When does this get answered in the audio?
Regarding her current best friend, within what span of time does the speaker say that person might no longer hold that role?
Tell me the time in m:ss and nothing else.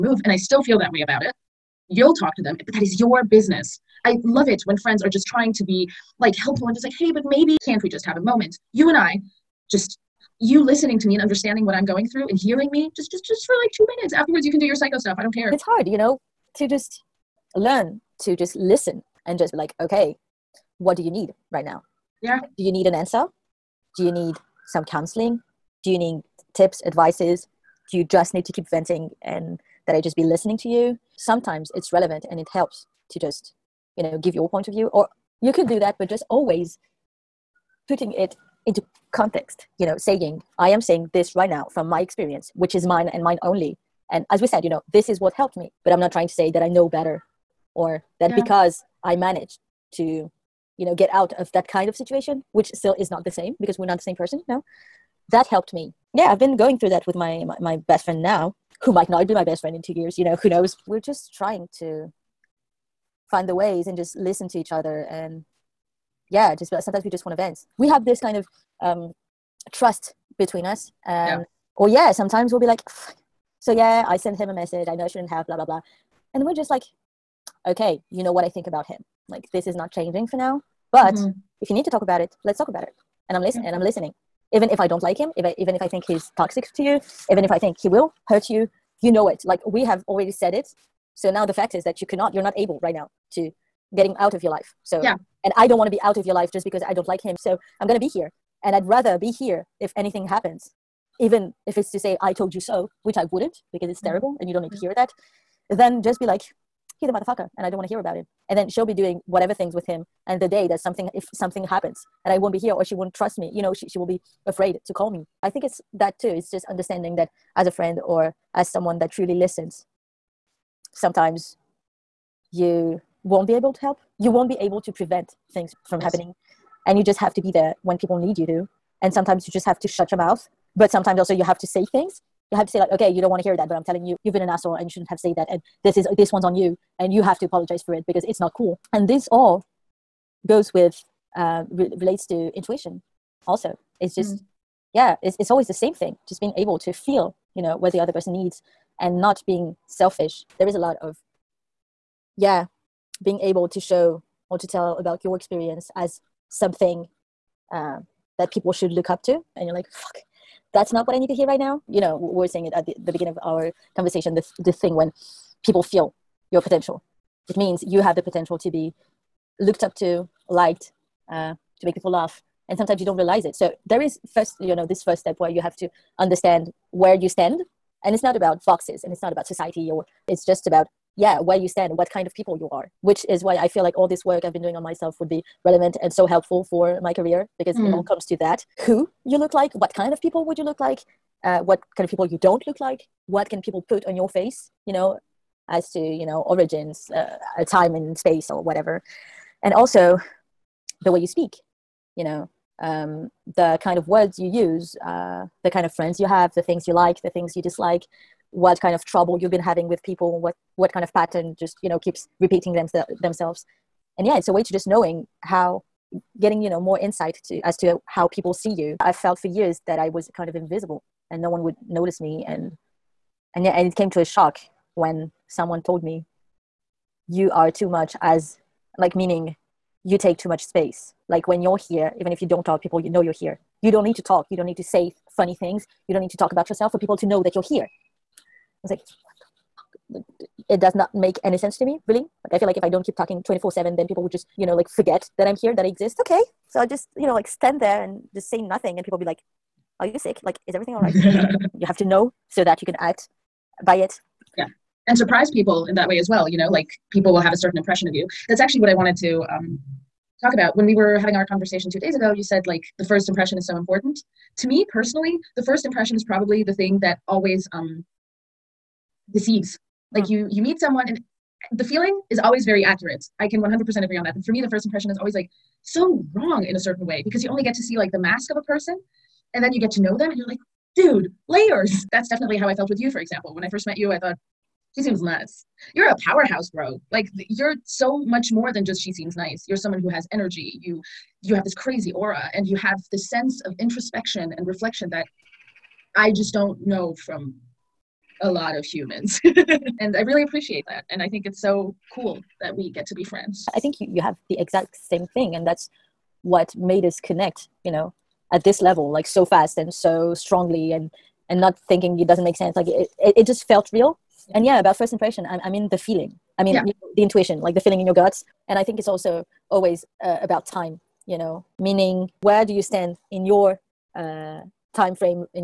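0:59.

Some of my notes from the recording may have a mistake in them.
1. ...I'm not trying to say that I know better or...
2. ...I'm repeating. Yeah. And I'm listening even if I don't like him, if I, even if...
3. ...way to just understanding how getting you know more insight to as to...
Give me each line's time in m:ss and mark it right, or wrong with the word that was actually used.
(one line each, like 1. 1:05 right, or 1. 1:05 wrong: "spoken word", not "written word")
1. 0:45 right
2. 1:23 wrong: "listening", not "repeating"
3. 3:34 wrong: "knowing", not "understanding".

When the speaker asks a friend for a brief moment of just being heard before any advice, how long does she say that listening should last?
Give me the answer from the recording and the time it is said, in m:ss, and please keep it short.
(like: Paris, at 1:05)
2 minutes, at 0:13.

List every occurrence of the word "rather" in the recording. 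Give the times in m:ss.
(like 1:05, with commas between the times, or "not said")
1:38.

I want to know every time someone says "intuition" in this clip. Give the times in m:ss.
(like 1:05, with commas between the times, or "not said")
2:22, 5:17.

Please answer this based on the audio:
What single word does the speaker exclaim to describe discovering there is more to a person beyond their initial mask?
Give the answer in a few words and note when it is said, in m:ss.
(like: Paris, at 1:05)
Layers, at 4:41.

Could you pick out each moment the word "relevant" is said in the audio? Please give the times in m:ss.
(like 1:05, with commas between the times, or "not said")
0:31, 3:05.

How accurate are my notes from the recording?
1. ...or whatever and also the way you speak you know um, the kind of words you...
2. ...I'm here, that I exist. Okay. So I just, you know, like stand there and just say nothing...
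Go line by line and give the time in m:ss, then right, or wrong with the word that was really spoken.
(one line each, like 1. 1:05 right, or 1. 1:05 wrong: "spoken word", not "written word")
1. 3:18 right
2. 4:05 right.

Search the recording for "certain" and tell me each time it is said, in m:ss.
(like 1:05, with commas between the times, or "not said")
4:17, 4:36.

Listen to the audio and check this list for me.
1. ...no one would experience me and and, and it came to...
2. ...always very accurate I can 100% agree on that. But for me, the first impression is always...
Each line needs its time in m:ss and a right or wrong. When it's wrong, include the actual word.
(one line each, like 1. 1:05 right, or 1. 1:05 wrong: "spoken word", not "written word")
1. 3:41 wrong: "notice", not "experience"
2. 4:32 right.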